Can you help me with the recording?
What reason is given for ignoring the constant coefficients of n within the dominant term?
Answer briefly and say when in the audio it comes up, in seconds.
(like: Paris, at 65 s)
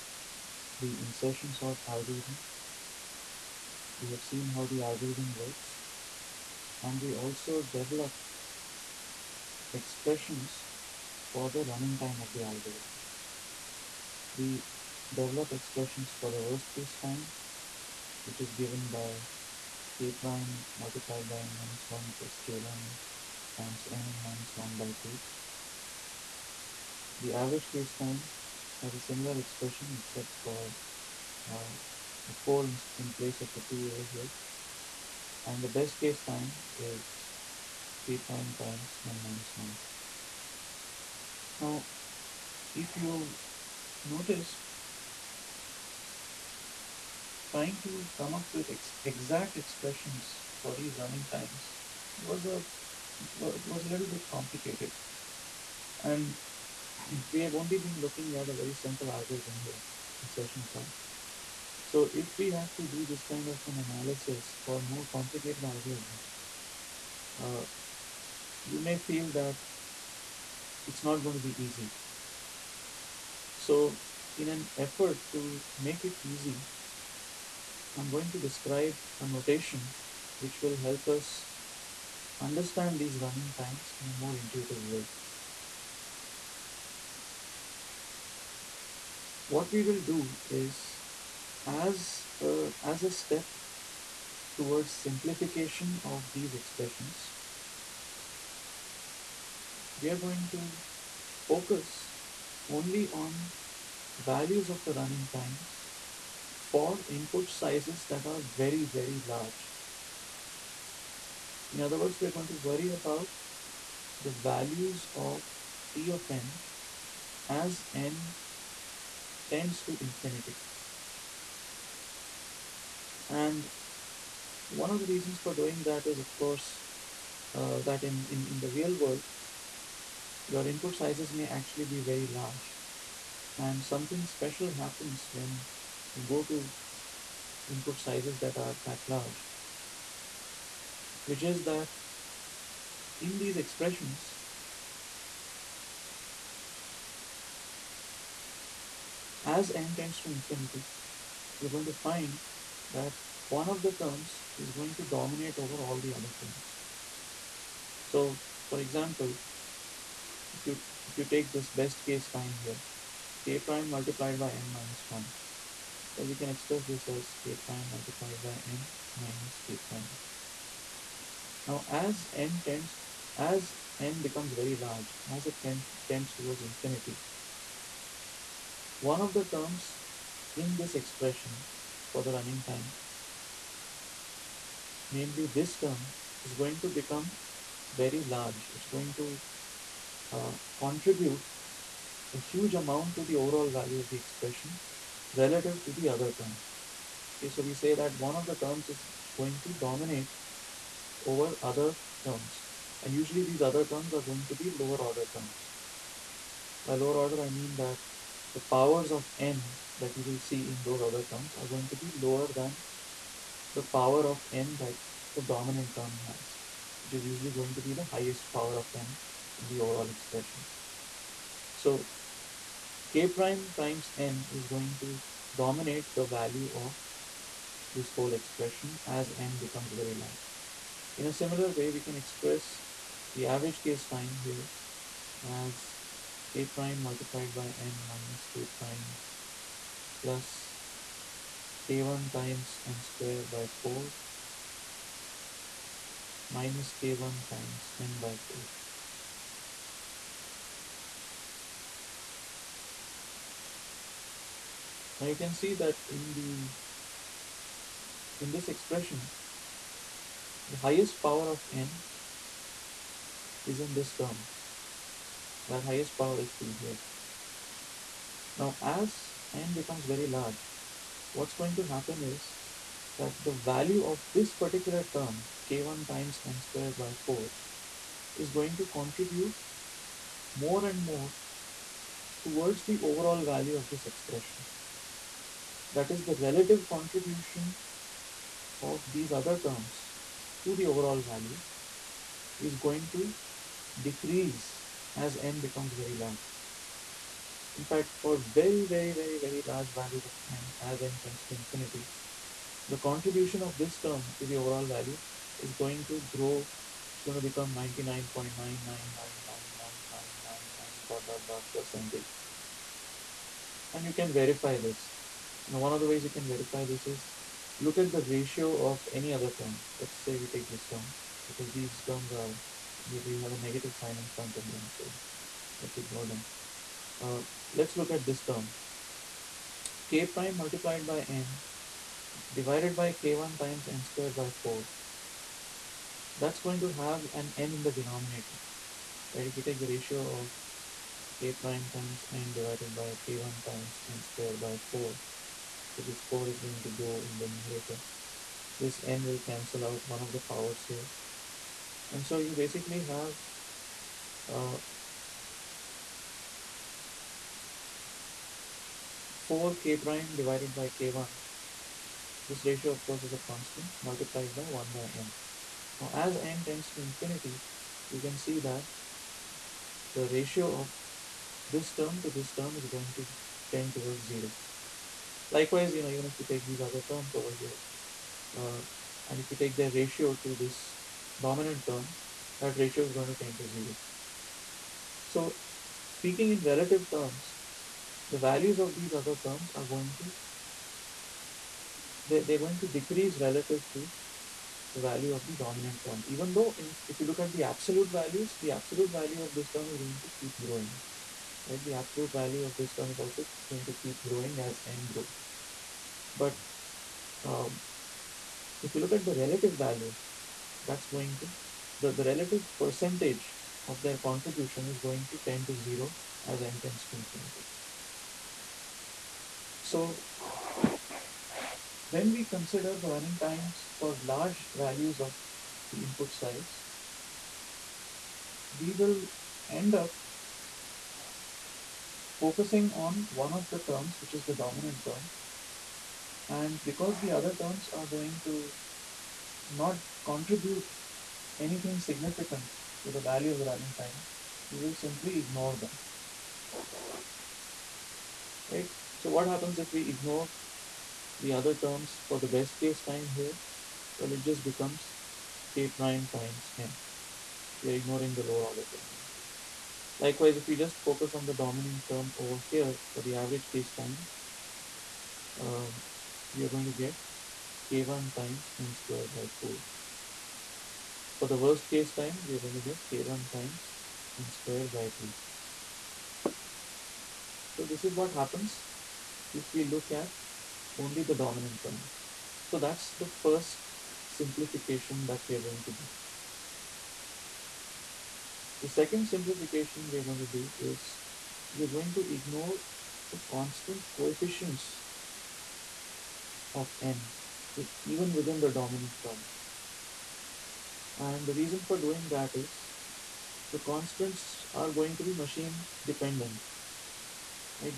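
Machine dependent, at 505 s.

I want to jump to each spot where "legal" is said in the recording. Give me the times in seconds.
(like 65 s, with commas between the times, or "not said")
not said.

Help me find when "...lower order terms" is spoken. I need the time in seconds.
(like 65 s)
204 s.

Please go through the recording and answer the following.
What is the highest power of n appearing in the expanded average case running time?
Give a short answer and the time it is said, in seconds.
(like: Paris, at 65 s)
2, at 265 s.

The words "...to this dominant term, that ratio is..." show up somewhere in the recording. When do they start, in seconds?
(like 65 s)
380 s.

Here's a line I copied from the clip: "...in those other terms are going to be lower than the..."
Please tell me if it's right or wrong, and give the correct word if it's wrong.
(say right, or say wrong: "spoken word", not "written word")
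right.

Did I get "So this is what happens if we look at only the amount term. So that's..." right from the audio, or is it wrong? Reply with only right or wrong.
wrong.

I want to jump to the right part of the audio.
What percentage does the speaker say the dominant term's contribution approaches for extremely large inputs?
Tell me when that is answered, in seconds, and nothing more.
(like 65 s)
307 s.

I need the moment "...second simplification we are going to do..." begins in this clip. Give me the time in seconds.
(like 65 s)
488 s.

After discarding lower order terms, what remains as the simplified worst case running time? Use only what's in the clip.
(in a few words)
k1 times n squared by 2.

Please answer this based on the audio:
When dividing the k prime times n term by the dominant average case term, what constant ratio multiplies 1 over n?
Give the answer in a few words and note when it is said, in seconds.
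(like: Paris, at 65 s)
4 k prime over k1, at 359 s.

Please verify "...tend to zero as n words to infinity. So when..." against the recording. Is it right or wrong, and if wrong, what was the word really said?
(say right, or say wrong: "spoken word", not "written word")
wrong: "tends", not "words".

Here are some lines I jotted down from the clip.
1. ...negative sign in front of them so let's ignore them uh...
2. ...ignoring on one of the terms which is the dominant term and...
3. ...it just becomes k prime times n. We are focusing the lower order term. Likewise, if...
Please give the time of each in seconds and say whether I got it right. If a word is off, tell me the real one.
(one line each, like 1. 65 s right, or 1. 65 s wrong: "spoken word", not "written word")
1. 323 s right
2. 432 s wrong: "focusing", not "ignoring"
3. 454 s wrong: "ignoring", not "focusing".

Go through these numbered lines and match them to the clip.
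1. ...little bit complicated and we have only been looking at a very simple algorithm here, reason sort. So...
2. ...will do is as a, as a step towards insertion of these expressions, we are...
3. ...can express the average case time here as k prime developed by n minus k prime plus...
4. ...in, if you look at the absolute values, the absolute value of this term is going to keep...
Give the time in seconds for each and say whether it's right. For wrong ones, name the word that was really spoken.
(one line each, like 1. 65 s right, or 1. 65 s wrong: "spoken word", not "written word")
1. 53 s wrong: "insertion", not "reason"
2. 89 s wrong: "simplification", not "insertion"
3. 232 s wrong: "multiplied", not "developed"
4. 396 s right.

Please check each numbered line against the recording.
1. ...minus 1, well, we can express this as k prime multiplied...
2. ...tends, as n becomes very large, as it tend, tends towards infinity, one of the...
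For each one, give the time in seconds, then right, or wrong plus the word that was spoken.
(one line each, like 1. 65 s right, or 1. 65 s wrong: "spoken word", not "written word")
1. 164 s right
2. 172 s right.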